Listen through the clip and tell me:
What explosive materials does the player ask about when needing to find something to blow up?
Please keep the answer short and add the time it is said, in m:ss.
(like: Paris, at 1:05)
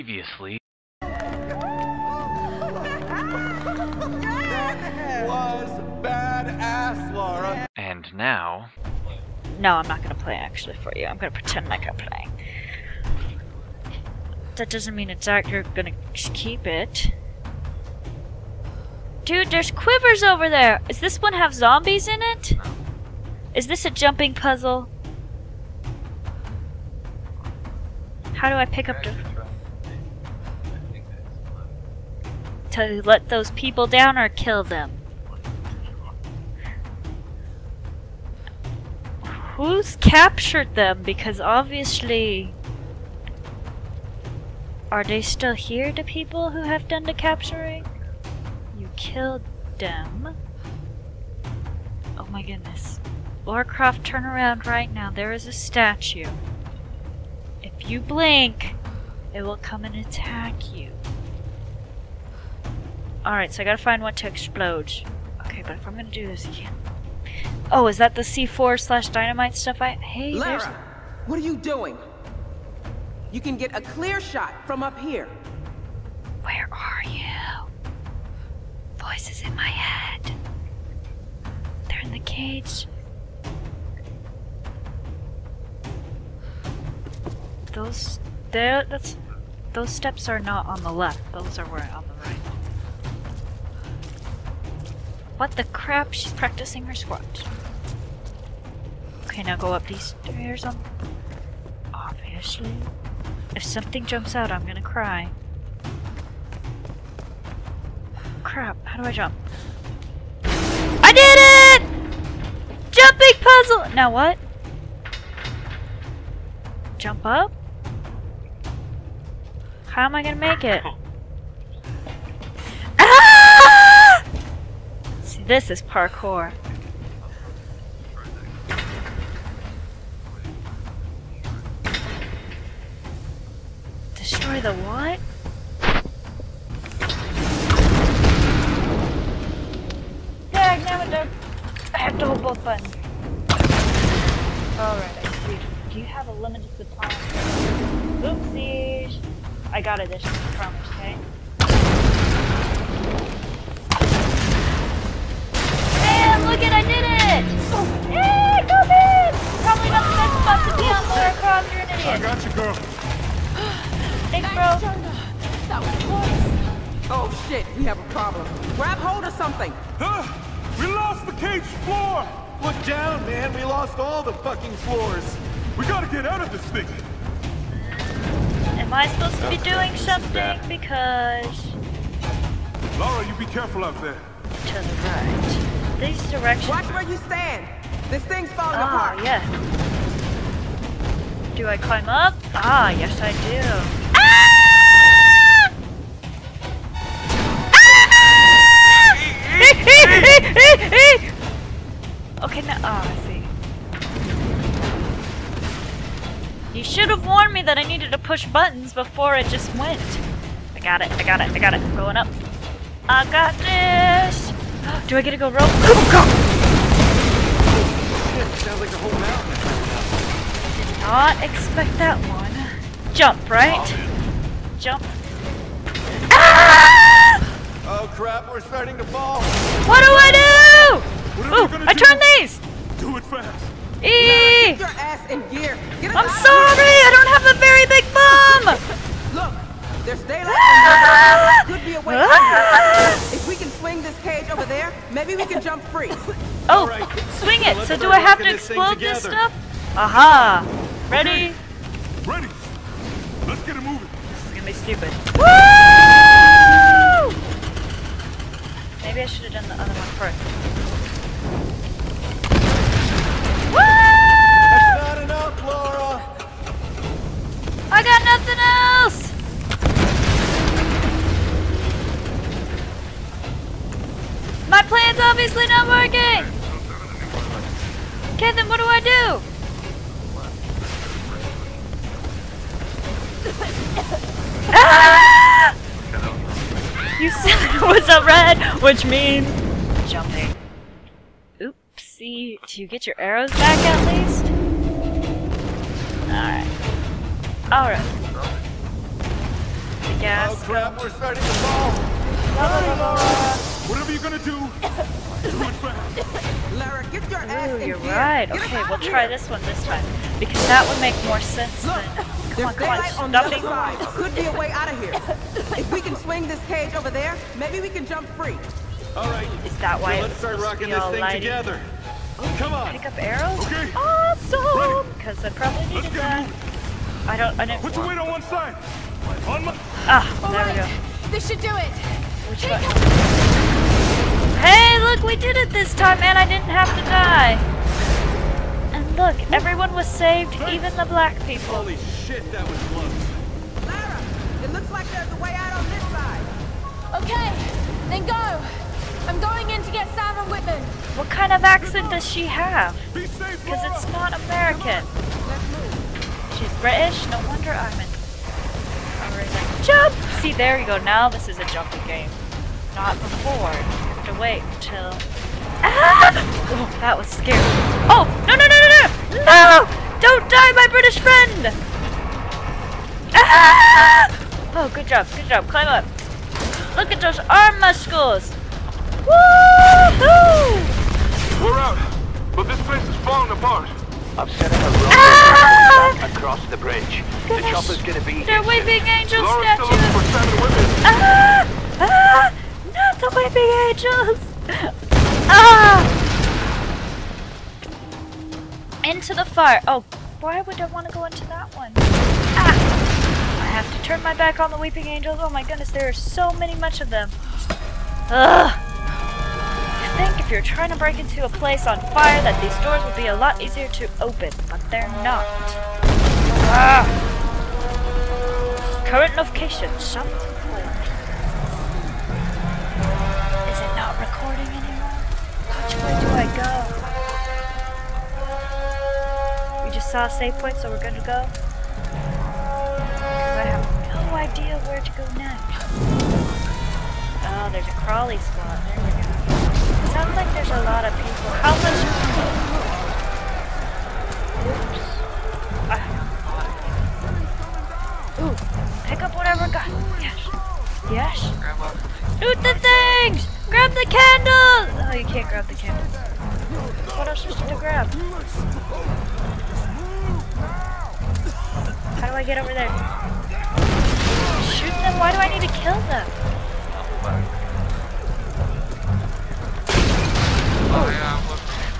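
C4 slash dynamite, at 1:08.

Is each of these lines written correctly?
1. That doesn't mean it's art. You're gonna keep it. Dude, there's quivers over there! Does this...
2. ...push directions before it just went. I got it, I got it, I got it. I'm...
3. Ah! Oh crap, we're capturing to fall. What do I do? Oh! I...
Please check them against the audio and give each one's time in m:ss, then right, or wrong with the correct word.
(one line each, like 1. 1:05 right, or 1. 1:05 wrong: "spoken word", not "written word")
1. 0:14 right
2. 3:28 wrong: "buttons", not "directions"
3. 3:46 wrong: "starting", not "capturing".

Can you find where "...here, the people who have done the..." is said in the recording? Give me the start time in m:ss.
0:45.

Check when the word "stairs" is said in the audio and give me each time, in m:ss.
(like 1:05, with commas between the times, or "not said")
1:40.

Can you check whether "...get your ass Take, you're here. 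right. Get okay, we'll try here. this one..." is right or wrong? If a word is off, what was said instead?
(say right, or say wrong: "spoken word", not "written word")
wrong: "Ooh", not "Take".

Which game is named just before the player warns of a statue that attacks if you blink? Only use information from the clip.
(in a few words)
Warcraft.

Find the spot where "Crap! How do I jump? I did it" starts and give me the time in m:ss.
1:48.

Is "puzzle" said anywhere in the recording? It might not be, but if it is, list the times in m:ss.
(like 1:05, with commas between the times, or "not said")
0:24, 1:53.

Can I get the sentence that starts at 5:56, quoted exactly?
She's British, no wonder I'm in.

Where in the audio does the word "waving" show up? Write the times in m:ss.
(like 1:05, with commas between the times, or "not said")
6:28.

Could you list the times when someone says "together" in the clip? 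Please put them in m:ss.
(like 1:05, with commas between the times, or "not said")
5:21.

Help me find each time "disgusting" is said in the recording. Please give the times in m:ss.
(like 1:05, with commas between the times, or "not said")
not said.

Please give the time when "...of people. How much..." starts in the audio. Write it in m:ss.
7:21.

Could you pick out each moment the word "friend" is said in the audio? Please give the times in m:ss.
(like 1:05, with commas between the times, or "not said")
6:11.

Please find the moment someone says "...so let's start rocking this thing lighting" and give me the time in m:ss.
5:20.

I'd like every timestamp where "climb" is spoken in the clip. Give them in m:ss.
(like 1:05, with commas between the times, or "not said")
3:11, 6:15.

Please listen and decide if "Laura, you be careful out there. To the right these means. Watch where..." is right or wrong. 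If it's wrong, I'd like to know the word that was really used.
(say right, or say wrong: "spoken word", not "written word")
wrong: "directions", not "means".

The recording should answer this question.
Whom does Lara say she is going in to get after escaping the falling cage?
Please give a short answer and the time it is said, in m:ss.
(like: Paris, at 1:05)
Simon Whitman, at 5:50.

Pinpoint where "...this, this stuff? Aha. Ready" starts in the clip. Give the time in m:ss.
4:08.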